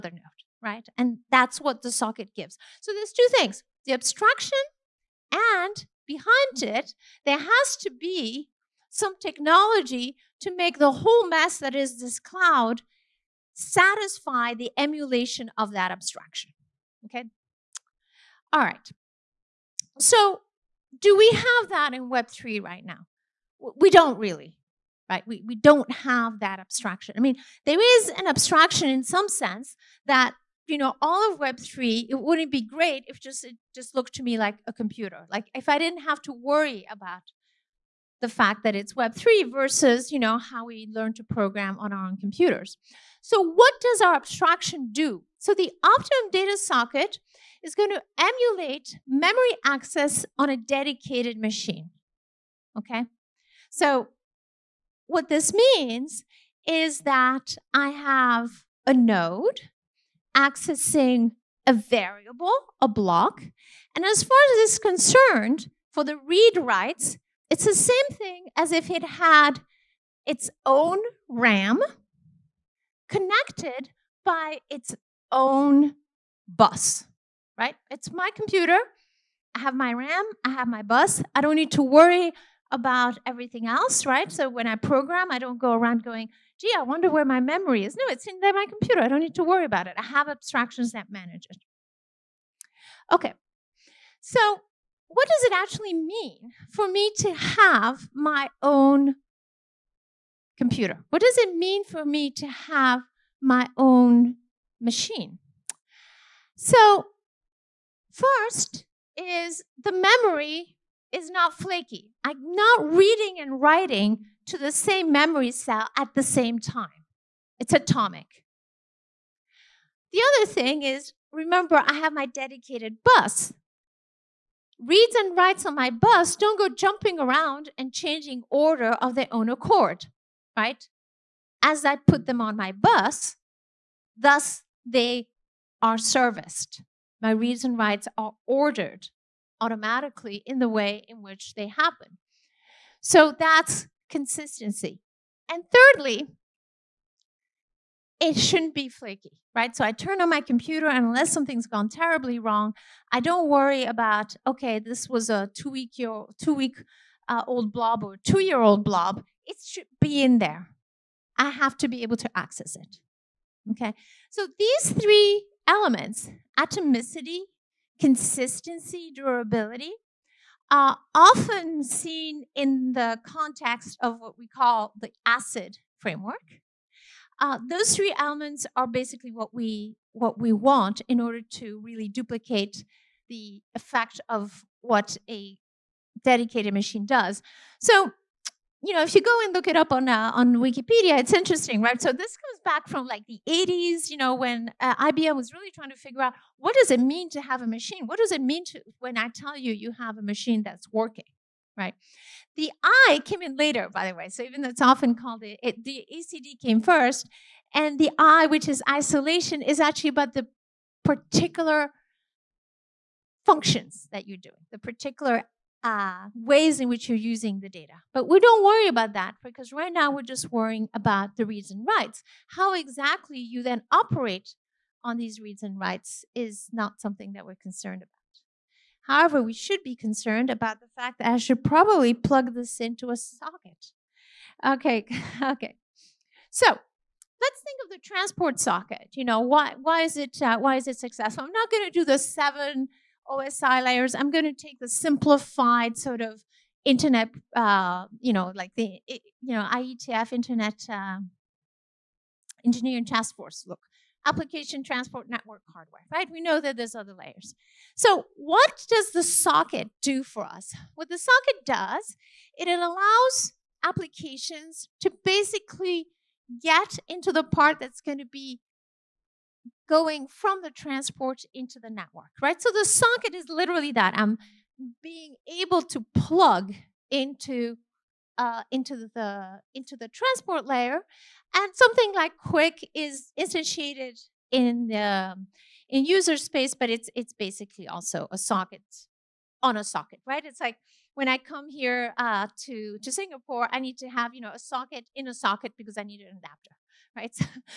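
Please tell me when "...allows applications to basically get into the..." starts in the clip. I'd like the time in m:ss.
4:22.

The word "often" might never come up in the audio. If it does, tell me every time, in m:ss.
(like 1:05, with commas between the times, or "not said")
2:51, 3:24.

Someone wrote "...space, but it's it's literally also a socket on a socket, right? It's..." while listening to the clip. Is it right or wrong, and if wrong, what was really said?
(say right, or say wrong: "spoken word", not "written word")
wrong: "basically", not "literally".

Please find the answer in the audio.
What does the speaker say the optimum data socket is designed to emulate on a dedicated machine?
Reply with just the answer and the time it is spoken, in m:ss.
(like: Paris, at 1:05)
Memory access, at 0:49.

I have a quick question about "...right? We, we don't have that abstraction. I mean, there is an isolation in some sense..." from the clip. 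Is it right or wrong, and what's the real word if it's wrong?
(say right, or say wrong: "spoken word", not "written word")
wrong: "abstraction", not "isolation".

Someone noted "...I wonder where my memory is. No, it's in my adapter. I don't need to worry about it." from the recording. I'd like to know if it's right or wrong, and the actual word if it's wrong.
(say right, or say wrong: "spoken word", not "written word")
wrong: "computer", not "adapter".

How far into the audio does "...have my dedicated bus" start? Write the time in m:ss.
2:01.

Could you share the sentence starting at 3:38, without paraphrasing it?
But we don't worry about that because right now we're just worrying about the reads and writes.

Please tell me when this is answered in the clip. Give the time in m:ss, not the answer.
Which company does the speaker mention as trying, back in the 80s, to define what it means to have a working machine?
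3:15.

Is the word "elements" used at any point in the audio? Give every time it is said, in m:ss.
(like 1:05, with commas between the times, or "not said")
2:45, 2:58.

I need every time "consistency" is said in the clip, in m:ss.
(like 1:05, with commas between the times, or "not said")
2:24, 2:47.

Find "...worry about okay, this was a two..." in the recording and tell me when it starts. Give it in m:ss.
2:33.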